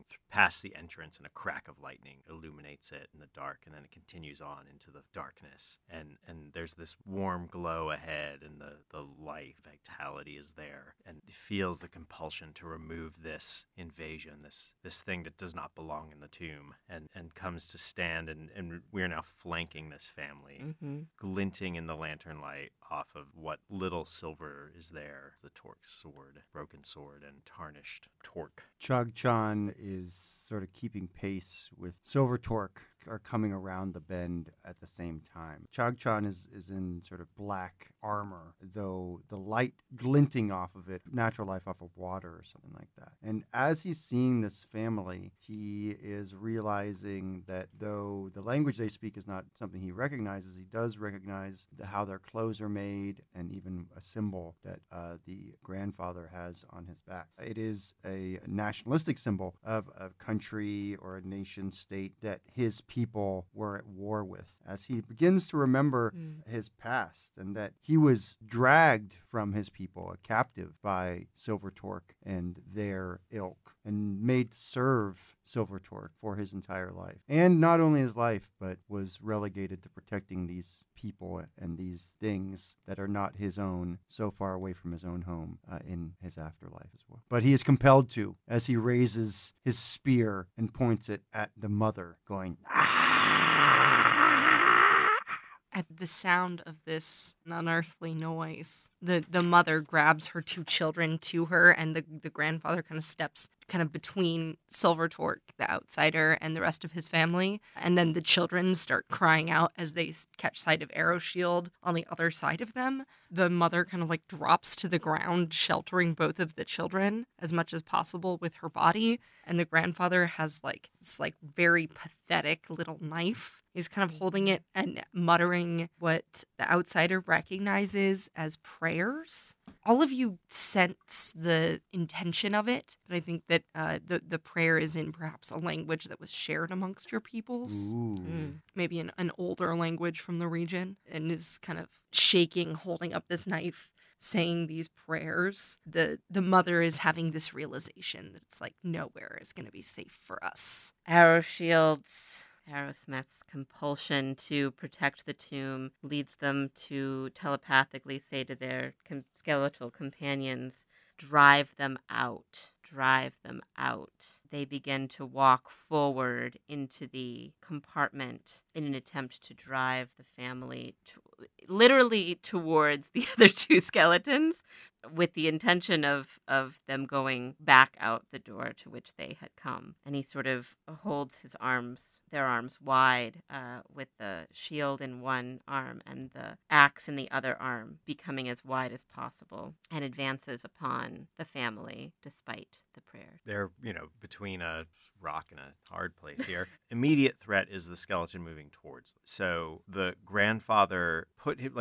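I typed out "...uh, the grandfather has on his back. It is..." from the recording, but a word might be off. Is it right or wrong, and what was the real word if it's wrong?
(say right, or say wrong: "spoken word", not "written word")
right.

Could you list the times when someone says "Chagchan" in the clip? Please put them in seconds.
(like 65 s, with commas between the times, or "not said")
28 s, 35 s.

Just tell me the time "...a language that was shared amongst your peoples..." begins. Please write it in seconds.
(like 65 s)
135 s.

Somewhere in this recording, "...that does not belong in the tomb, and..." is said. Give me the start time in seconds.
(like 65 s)
15 s.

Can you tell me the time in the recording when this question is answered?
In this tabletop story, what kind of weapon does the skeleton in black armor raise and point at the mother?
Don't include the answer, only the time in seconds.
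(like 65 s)
89 s.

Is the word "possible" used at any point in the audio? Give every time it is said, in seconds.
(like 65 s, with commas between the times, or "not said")
117 s, 189 s.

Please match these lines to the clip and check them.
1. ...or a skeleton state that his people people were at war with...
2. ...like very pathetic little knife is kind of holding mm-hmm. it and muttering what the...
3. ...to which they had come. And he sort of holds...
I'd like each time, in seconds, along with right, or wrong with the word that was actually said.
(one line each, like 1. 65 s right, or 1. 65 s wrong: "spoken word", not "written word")
1. 61 s wrong: "nation", not "skeleton"
2. 121 s right
3. 178 s right.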